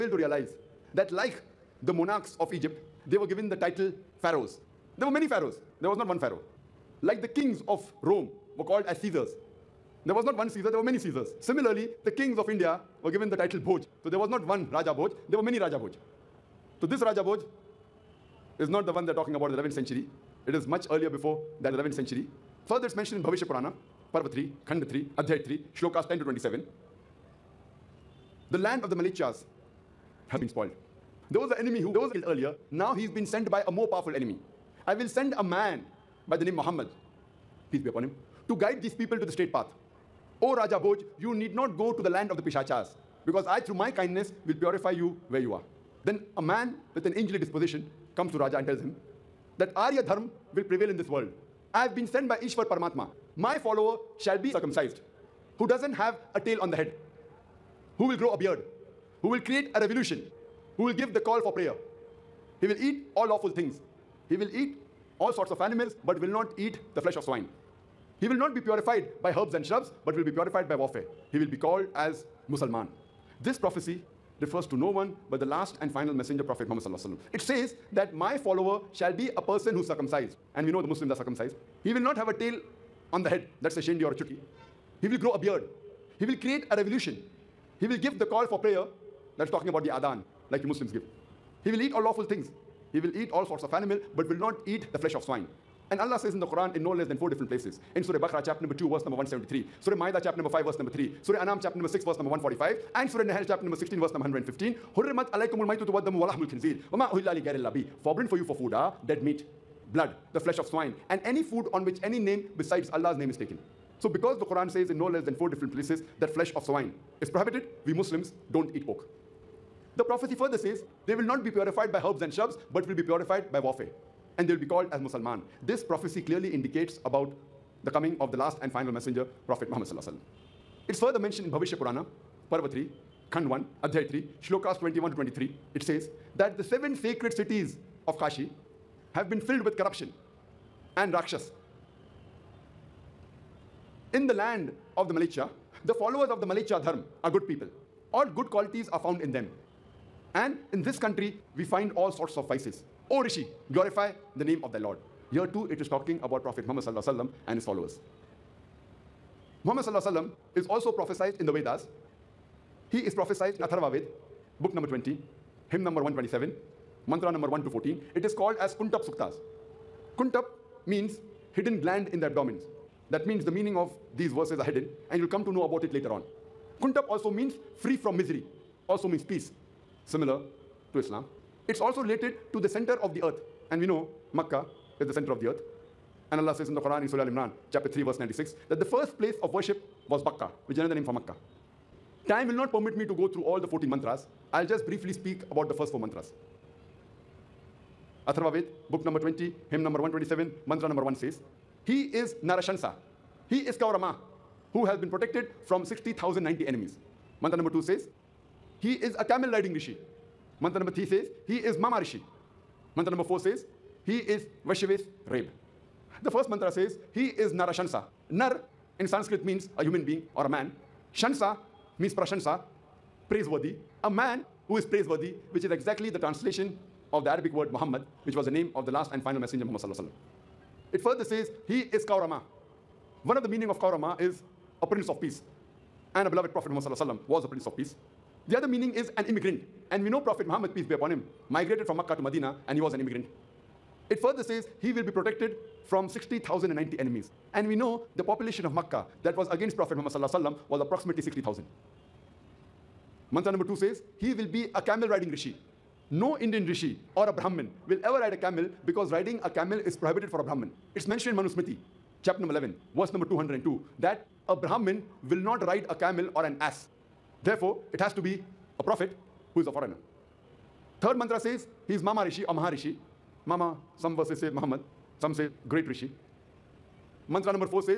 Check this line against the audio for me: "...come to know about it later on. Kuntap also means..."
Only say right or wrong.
right.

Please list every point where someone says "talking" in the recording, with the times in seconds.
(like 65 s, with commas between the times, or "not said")
19 s, 89 s, 155 s.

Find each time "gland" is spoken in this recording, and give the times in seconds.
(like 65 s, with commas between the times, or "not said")
171 s.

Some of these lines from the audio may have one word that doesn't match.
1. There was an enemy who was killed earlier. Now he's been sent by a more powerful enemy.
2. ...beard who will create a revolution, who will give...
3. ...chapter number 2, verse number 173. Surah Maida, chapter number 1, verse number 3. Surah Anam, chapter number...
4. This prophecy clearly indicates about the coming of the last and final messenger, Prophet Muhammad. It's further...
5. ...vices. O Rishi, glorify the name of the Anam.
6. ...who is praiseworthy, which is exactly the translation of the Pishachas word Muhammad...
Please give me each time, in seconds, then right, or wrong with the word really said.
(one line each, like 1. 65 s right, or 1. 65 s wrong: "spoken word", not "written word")
1. 31 s right
2. 58 s right
3. 98 s wrong: "5", not "1"
4. 125 s right
5. 152 s wrong: "Lord", not "Anam"
6. 224 s wrong: "Arabic", not "Pishachas".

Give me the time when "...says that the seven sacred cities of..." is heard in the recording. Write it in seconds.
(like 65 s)
135 s.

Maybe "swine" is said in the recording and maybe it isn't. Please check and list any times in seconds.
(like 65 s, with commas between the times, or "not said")
67 s, 95 s, 110 s, 116 s.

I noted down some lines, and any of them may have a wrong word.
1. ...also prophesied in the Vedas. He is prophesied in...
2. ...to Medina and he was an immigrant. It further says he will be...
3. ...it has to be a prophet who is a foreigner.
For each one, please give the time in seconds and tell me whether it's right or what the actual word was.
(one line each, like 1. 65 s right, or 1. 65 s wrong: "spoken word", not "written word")
1. 160 s right
2. 242 s right
3. 267 s right.